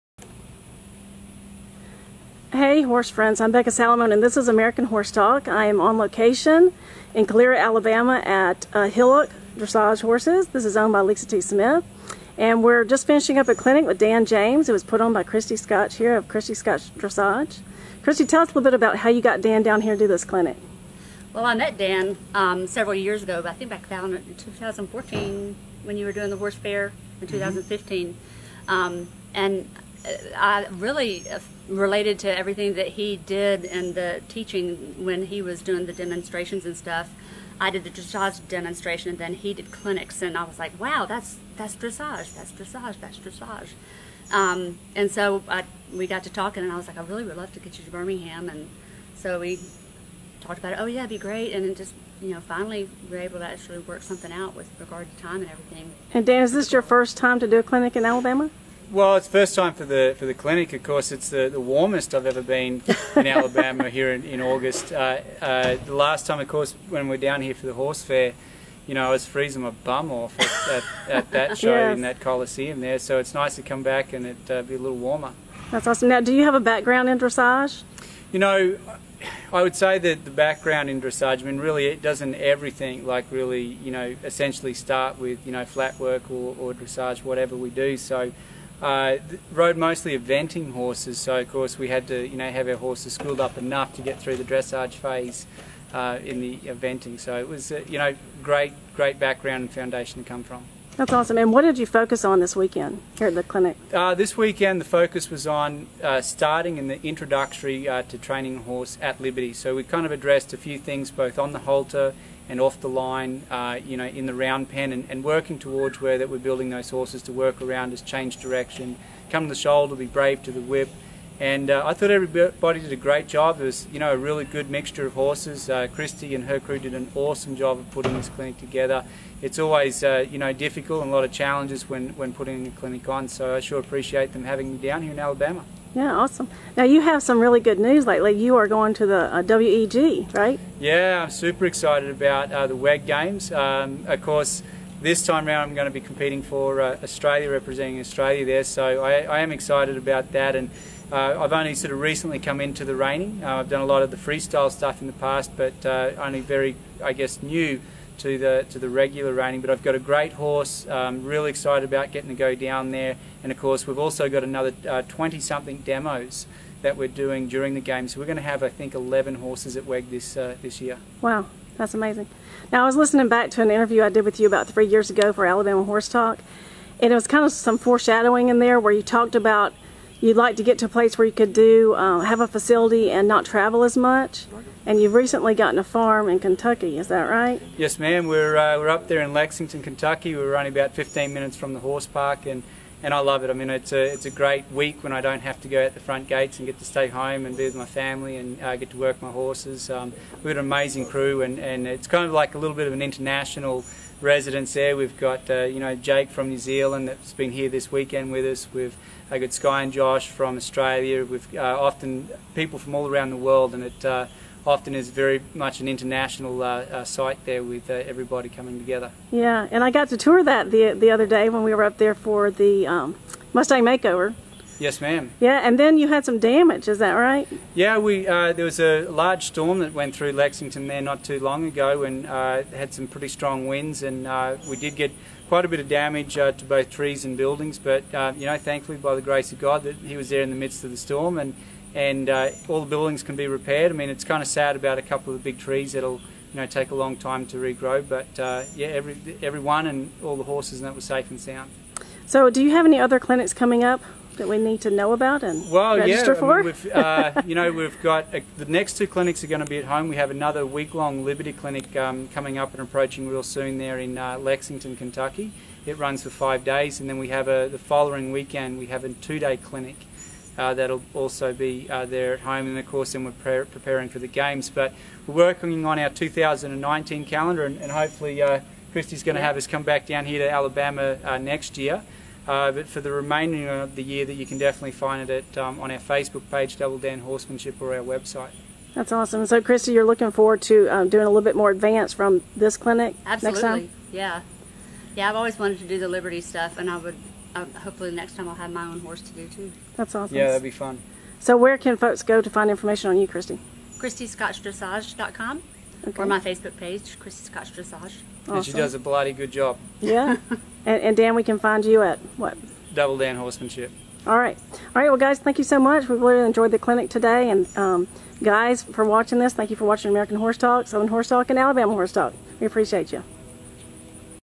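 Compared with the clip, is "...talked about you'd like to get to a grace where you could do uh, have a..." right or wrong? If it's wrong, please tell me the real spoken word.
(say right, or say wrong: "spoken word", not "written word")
wrong: "place", not "grace".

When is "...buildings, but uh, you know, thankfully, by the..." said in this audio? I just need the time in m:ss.
3:57.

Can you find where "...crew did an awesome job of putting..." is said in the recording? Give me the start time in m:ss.
2:06.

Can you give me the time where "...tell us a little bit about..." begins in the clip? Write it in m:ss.
0:18.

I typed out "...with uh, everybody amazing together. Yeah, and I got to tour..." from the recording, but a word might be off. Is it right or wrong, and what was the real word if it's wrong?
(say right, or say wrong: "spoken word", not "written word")
wrong: "coming", not "amazing".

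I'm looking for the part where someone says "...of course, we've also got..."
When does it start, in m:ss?
2:43.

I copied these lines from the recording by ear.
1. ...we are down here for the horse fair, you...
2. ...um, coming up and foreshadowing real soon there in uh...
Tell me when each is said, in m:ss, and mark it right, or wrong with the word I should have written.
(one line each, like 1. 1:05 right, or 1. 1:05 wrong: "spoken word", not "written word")
1. 1:07 right
2. 4:21 wrong: "approaching", not "foreshadowing".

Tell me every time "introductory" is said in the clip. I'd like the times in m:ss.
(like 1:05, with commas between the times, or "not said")
1:47.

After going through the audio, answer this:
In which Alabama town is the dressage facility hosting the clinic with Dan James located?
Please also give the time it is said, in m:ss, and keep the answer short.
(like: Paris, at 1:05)
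Calera, at 0:07.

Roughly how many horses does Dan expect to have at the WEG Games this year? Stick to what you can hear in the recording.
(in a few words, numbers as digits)
11.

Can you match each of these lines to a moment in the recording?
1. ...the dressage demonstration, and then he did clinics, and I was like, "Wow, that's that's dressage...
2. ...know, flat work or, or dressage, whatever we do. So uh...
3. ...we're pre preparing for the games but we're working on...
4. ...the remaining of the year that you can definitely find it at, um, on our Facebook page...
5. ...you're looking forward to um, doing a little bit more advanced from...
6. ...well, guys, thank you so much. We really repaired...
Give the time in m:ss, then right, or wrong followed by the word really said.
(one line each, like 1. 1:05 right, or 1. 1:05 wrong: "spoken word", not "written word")
1. 0:37 right
2. 1:25 right
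3. 4:33 right
4. 4:43 right
5. 4:49 right
6. 5:15 wrong: "enjoyed", not "repaired".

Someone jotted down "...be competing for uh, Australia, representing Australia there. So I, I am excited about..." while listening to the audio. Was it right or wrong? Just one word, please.
right.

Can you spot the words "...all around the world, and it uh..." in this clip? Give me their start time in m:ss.
3:32.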